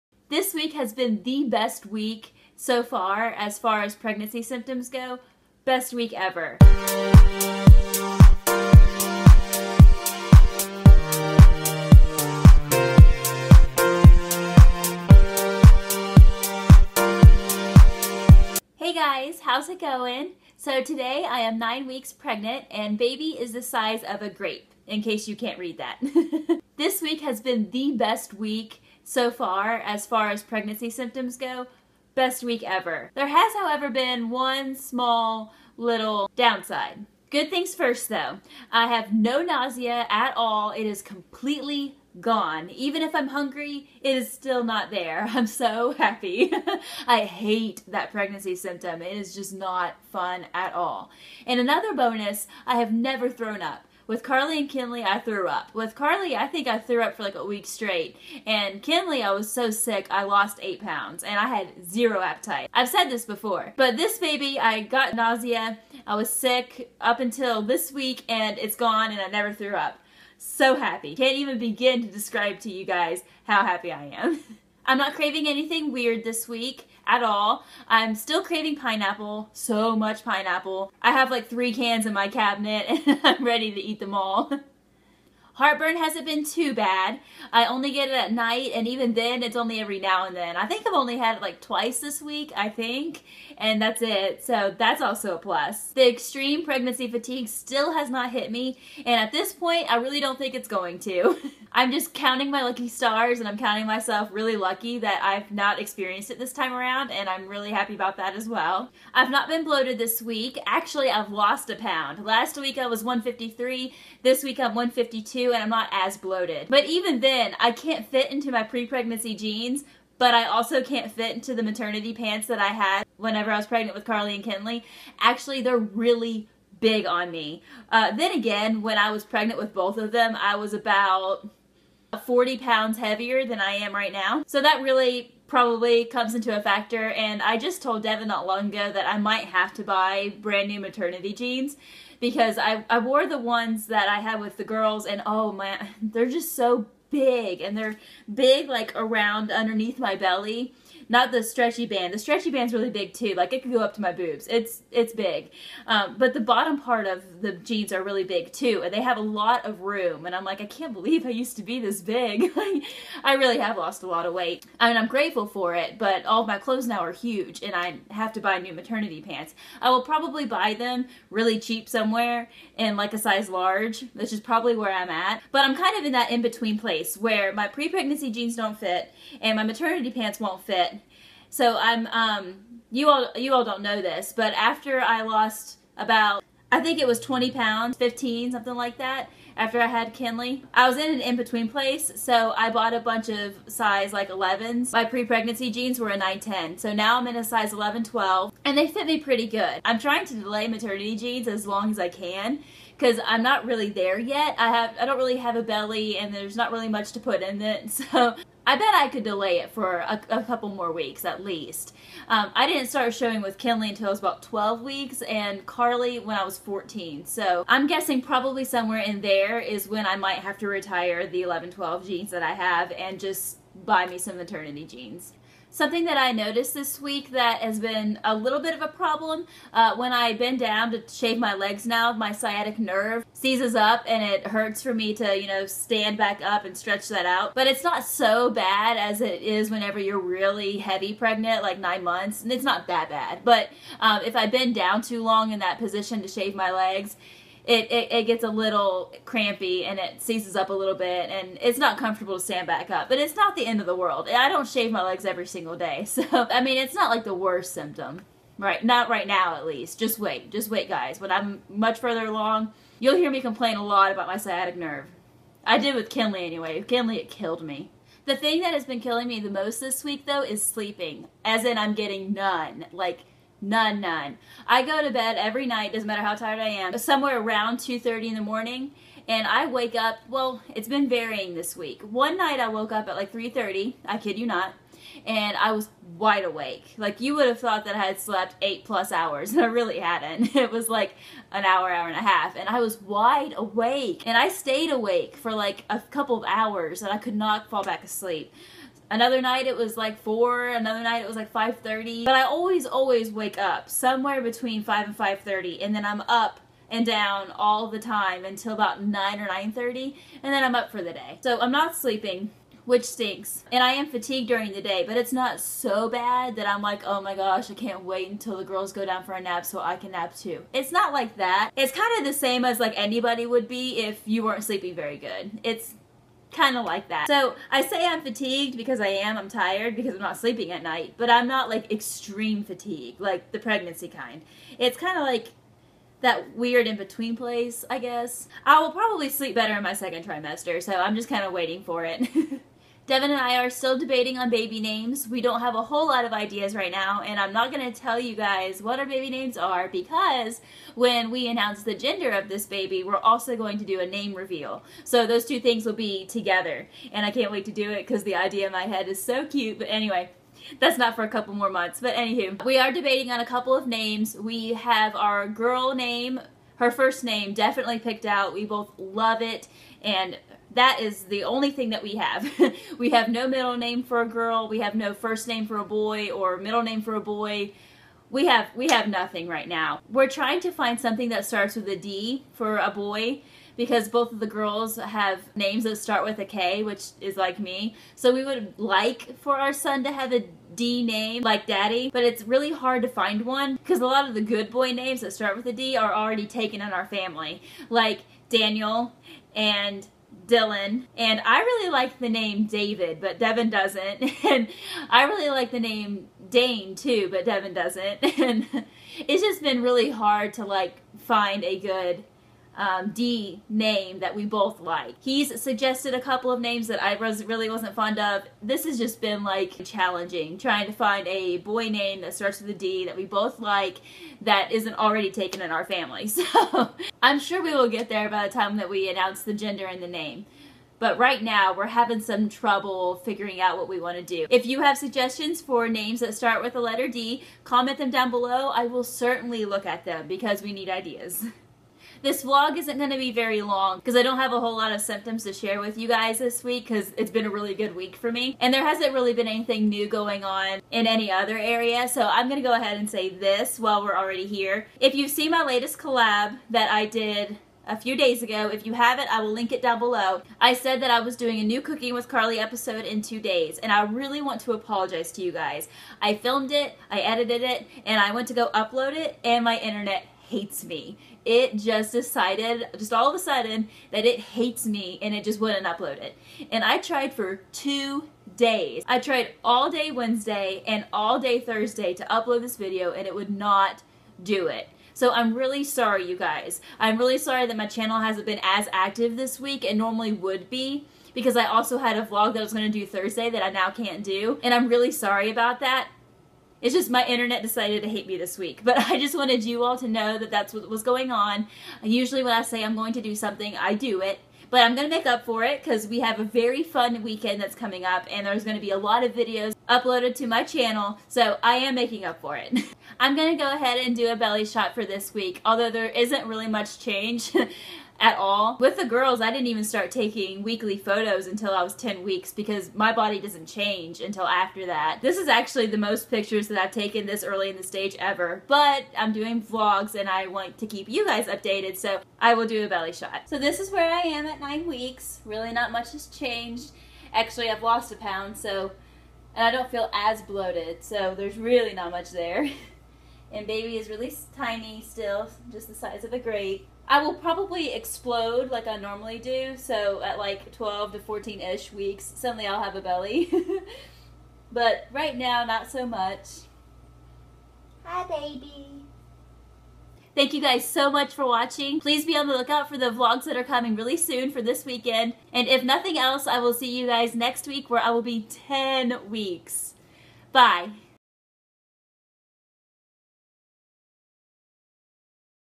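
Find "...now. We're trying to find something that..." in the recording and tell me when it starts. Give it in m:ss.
6:19.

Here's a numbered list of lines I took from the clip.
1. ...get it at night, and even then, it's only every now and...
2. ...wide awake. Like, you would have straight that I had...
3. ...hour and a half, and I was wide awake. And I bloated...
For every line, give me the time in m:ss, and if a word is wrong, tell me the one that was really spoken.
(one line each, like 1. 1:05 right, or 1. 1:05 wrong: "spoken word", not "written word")
1. 1:27 right
2. 4:46 wrong: "thought", not "straight"
3. 4:51 wrong: "stayed", not "bloated".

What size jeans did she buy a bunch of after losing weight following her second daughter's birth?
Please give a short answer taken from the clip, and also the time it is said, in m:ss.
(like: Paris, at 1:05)
11, at 3:13.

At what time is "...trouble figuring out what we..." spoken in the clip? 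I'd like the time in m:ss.
7:12.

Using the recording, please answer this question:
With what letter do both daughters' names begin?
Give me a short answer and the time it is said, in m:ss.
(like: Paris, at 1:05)
K, at 6:26.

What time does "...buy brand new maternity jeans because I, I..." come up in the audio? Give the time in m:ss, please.
2:19.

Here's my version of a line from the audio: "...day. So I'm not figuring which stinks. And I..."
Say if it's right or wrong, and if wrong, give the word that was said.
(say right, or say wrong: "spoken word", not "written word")
wrong: "sleeping", not "figuring".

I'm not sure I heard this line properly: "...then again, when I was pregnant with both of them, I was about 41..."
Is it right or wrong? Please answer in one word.
wrong.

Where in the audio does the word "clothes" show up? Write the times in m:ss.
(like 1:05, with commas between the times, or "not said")
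2:46.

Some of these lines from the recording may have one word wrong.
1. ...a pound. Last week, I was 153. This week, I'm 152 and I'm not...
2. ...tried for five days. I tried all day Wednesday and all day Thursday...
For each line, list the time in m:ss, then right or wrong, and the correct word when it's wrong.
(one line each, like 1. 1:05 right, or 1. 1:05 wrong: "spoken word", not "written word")
1. 1:51 right
2. 7:56 wrong: "two", not "five".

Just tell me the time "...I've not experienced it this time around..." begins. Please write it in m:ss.
1:45.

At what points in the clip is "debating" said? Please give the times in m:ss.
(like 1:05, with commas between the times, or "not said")
5:43, 6:02.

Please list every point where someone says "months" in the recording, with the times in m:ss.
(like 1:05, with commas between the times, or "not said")
4:02, 6:01.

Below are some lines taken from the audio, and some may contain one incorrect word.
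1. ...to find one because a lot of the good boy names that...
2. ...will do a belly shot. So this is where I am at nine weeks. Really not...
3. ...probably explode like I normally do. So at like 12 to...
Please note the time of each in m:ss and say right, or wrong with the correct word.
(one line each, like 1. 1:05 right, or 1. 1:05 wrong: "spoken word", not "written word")
1. 6:33 right
2. 8:52 right
3. 9:07 right.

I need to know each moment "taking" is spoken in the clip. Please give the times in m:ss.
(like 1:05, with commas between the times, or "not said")
8:40.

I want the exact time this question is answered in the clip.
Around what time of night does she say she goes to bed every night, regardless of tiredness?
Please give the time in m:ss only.
4:37.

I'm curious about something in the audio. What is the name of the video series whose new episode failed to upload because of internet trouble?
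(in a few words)
Cooking with Carly.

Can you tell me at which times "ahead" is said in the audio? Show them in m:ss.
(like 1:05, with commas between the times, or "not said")
7:32, 8:33.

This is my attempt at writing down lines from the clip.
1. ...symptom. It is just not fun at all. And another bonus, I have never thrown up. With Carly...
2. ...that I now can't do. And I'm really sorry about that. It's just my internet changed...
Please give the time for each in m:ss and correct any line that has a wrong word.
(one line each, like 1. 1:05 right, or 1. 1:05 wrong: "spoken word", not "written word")
1. 0:48 right
2. 8:13 wrong: "decided", not "changed".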